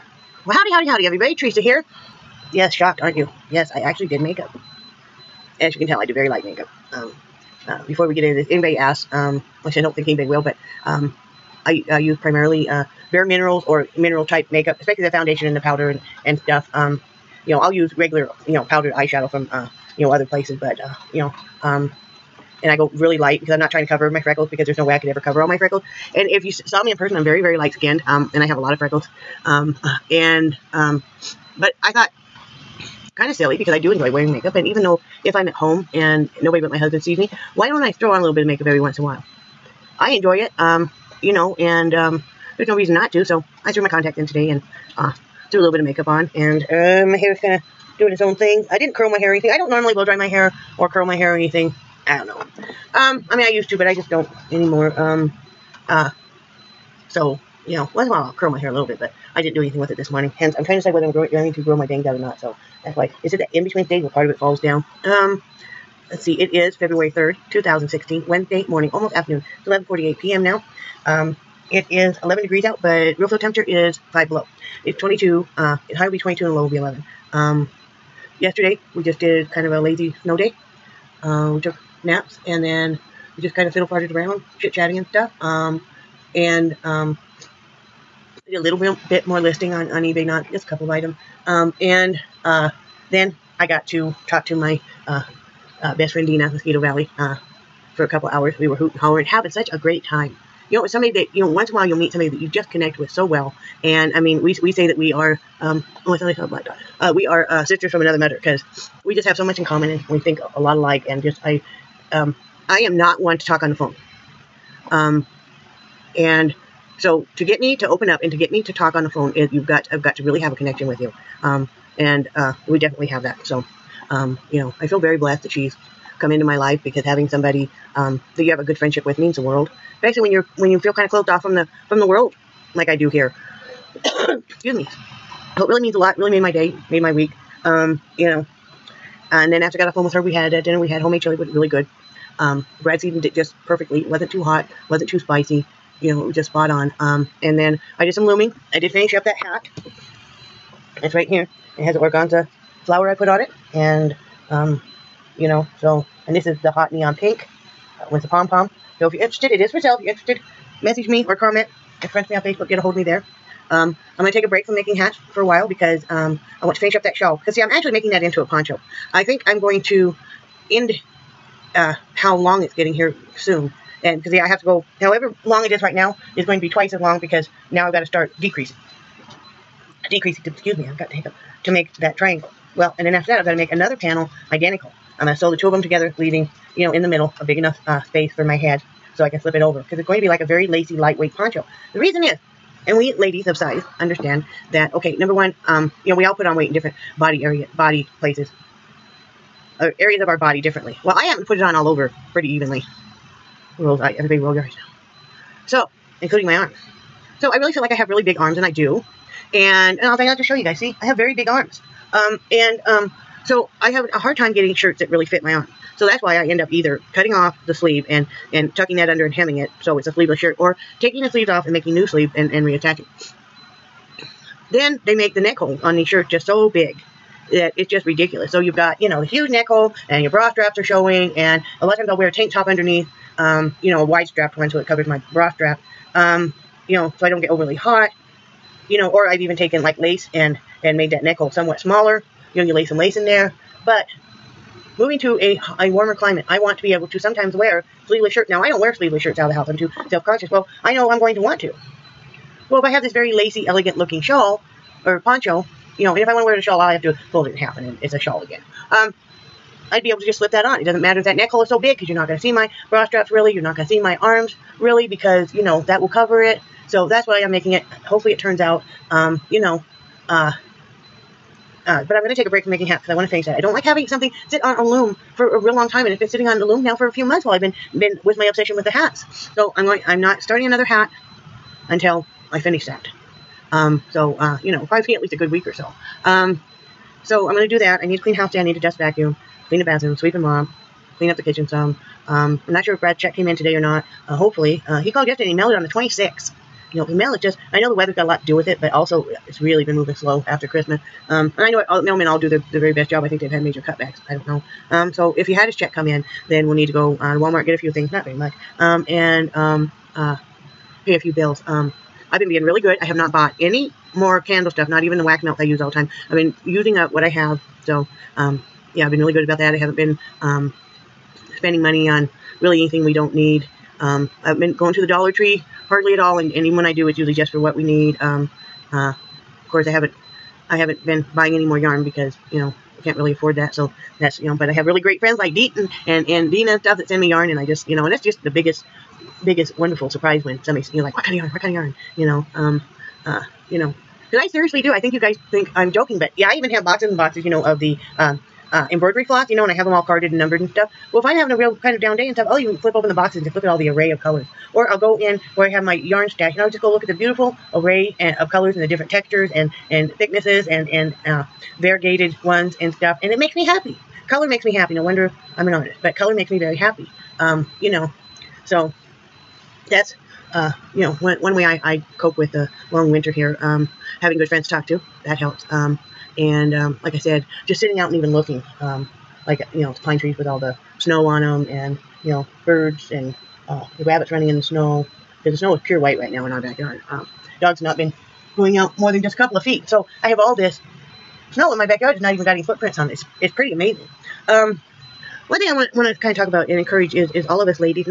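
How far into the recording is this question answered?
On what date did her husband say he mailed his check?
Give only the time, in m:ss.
4:55.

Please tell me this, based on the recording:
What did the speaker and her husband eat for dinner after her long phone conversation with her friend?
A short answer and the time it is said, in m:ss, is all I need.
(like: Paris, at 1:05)
Homemade chili, at 2:20.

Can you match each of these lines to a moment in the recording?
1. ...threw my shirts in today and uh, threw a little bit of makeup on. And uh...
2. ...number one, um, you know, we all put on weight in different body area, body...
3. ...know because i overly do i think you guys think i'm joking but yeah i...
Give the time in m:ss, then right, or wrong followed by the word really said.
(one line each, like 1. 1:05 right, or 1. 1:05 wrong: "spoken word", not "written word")
1. 0:43 wrong: "contacts", not "shirts"
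2. 3:15 right
3. 5:43 wrong: "seriously", not "overly".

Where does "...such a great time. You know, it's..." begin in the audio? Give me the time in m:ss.
1:39.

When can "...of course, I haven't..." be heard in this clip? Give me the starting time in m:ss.
5:29.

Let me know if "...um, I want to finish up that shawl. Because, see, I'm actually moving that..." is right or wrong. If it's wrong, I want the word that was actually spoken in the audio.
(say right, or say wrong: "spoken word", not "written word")
wrong: "making", not "moving".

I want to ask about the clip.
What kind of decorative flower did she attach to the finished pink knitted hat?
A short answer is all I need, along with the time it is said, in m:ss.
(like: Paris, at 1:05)
Organza flower, at 2:31.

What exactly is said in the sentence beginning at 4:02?
You know, you lay some lace in there.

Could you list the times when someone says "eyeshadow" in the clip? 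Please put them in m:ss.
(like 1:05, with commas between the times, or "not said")
0:18.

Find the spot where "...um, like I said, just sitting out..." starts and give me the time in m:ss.
6:16.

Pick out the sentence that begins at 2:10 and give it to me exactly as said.
Basically, when you're when you feel kind of closed off from the from the world, like I do here.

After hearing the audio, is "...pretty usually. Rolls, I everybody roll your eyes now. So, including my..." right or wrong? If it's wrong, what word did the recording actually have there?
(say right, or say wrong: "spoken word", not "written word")
wrong: "evenly", not "usually".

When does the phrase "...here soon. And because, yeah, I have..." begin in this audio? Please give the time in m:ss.
2:52.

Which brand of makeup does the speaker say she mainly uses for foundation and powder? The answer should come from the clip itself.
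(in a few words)
Bare Minerals.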